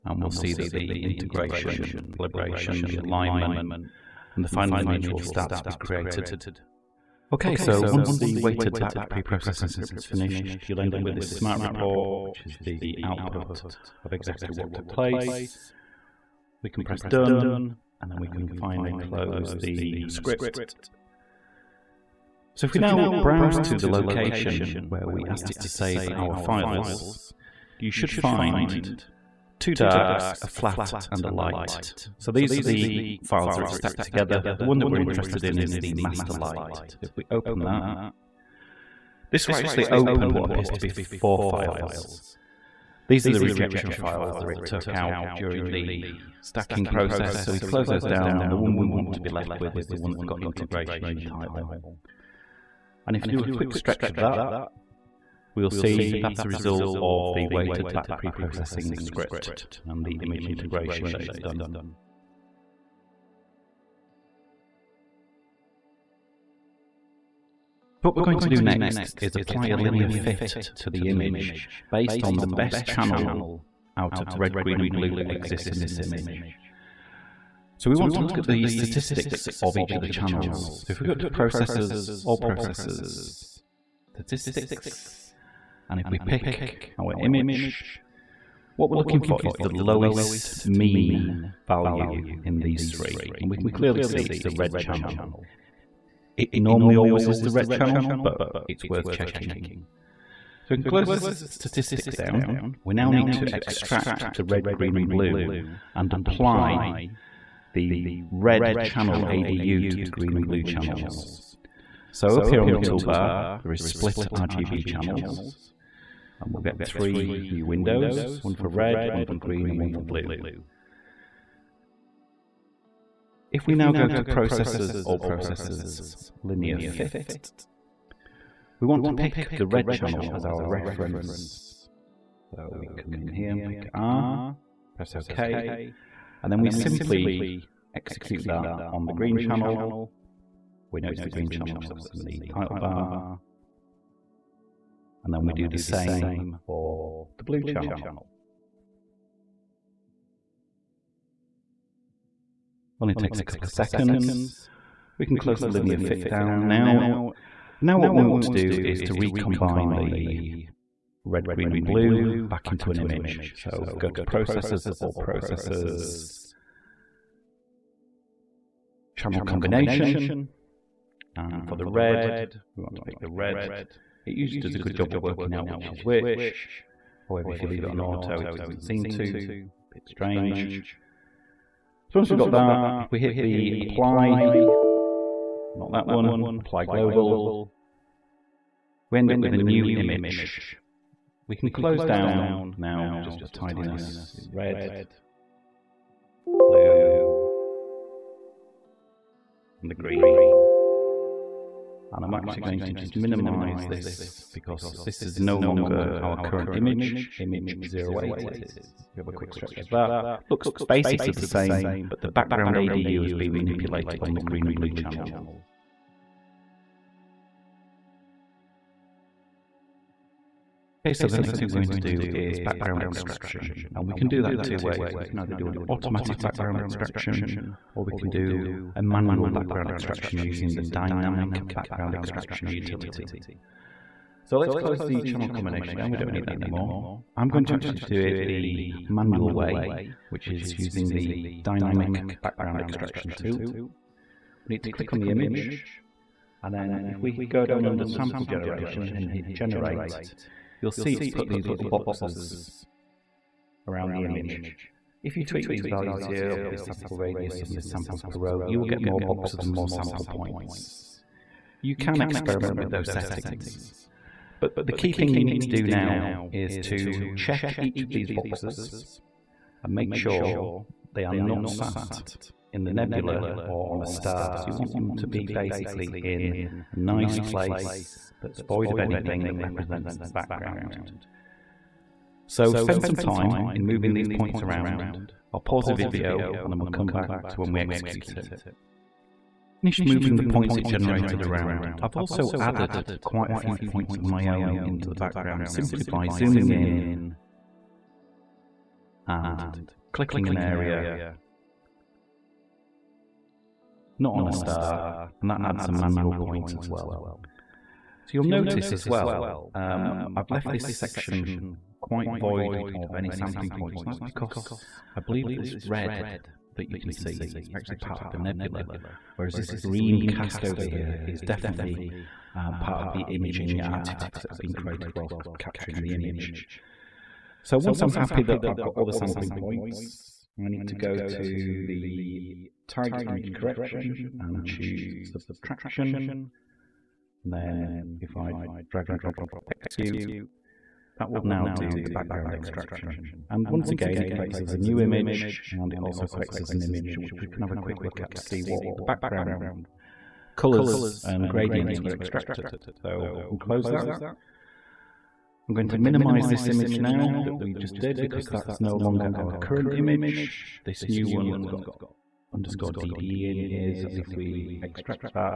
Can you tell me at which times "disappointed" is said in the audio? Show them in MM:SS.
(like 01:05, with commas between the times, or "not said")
not said.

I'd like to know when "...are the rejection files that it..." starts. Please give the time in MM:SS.
00:43.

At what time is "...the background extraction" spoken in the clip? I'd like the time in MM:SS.
05:41.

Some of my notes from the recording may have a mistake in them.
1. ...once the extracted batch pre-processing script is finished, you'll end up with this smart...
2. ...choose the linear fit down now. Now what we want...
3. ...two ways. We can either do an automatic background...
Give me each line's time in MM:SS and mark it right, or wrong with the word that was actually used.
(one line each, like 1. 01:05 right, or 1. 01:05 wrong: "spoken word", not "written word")
1. 00:07 wrong: "weighted", not "extracted"
2. 02:35 wrong: "close", not "choose"
3. 03:44 right.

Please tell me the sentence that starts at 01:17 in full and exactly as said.
So we want to look at the statistics of each of the channels.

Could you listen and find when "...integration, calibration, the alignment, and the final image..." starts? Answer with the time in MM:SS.
00:01.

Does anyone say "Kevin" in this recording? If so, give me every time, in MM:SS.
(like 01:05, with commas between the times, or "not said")
not said.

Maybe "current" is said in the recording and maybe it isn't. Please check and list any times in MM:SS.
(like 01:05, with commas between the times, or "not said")
03:26, 05:59.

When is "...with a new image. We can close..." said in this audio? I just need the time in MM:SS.
03:09.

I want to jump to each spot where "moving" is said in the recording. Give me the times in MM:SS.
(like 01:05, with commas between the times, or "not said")
04:43, 04:50.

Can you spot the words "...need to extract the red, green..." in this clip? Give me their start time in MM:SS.
01:43.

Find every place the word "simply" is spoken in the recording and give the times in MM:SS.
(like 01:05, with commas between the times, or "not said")
02:16, 04:55.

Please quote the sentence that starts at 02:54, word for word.
It usually does a good job at working out which is which.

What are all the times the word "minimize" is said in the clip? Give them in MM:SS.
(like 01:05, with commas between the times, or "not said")
03:23, 05:55.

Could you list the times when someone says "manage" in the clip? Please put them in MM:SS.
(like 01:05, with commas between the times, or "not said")
not said.